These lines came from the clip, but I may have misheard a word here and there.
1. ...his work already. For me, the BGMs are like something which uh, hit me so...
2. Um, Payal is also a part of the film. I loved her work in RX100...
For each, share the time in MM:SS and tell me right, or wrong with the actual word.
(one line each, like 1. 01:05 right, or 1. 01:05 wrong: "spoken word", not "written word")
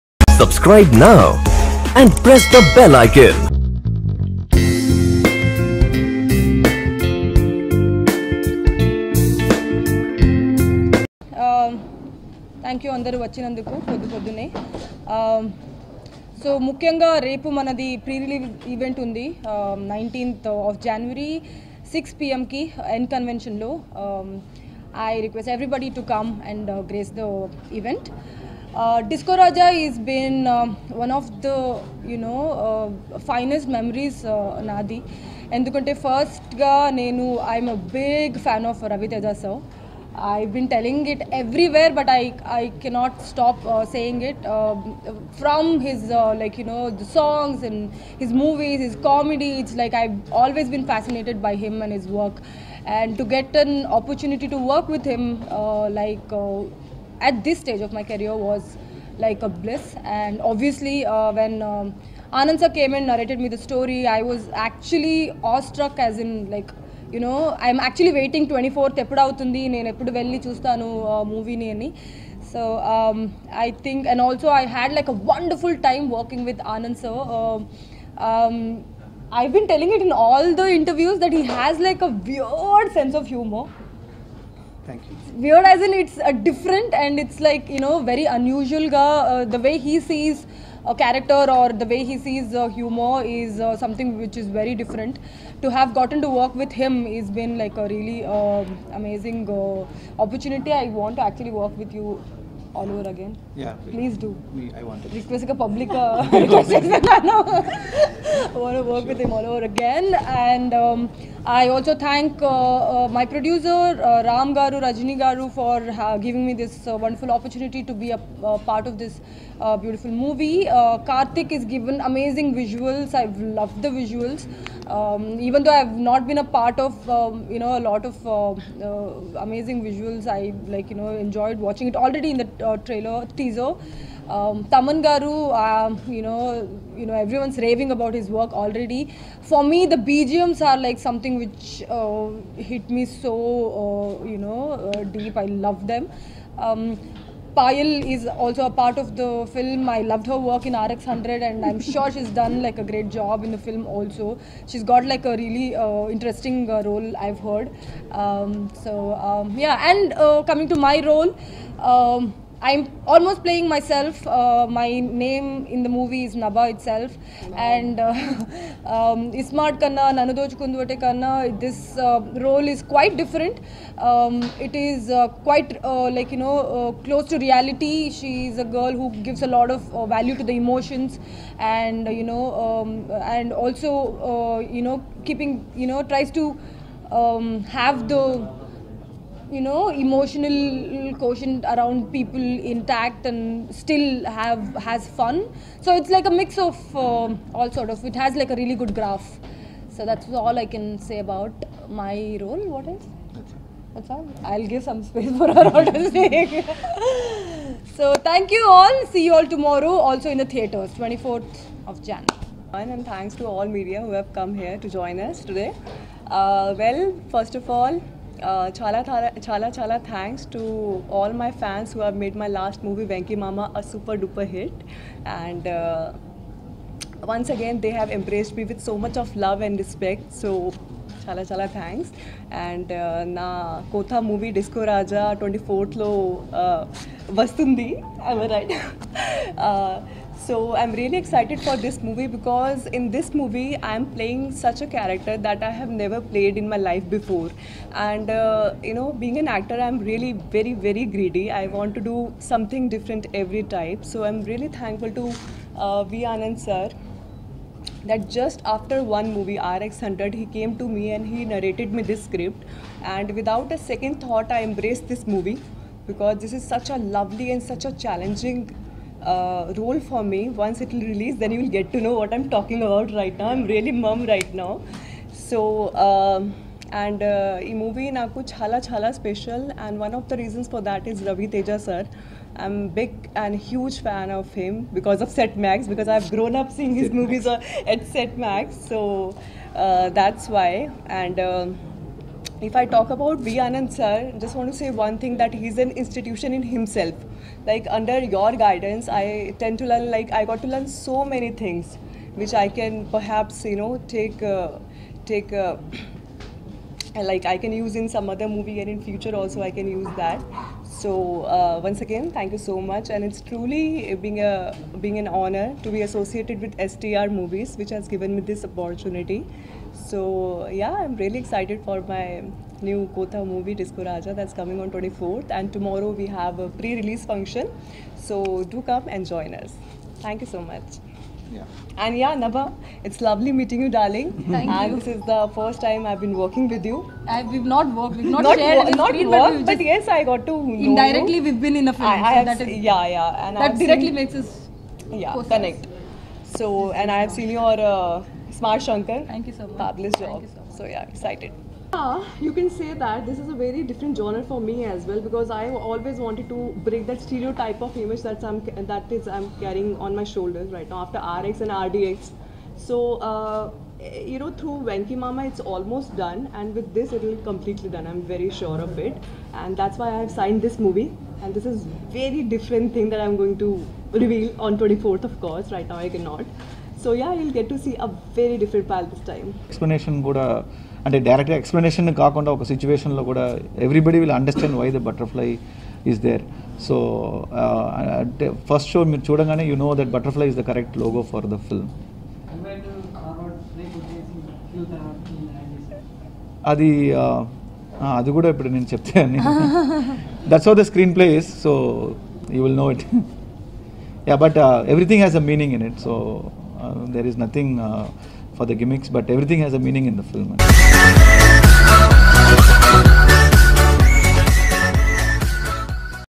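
1. 02:18 right
2. 02:26 right.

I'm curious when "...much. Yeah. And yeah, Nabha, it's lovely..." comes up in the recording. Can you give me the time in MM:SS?
05:30.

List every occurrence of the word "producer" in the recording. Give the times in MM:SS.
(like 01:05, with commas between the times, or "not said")
01:53.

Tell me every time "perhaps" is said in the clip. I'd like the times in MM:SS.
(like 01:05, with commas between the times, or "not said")
05:03.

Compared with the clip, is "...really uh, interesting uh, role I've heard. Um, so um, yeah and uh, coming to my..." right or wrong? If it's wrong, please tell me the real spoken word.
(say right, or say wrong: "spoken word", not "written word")
right.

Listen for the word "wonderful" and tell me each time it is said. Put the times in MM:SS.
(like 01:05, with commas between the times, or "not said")
01:15, 01:56.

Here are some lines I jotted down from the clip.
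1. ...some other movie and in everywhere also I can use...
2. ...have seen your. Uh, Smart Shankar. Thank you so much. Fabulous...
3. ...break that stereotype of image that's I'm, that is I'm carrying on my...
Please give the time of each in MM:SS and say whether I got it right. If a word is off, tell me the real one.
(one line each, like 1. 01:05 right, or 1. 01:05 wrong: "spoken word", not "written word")
1. 05:08 wrong: "future", not "everywhere"
2. 05:47 right
3. 05:56 right.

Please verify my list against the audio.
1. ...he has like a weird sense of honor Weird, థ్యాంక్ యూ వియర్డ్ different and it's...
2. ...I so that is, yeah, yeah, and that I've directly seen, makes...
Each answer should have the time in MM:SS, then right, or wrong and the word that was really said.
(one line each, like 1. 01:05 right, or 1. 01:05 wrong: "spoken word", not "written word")
1. 01:21 wrong: "humor", not "honor"
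2. 05:42 right.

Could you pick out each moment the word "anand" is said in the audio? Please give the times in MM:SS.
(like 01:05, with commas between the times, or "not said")
01:02, 01:16, 04:16, 04:53.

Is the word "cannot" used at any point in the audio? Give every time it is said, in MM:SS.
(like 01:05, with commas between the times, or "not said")
00:42, 06:16.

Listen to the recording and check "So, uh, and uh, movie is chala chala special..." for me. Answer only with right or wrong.
right.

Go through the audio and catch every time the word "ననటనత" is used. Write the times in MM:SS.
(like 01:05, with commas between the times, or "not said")
00:19.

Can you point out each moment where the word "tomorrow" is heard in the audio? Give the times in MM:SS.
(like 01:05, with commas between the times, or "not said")
03:29, 05:25.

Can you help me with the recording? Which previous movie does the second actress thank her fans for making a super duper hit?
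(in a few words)
Venky Mama.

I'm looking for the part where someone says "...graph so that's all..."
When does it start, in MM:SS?
03:18.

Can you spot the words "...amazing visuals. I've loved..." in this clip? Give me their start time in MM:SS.
02:02.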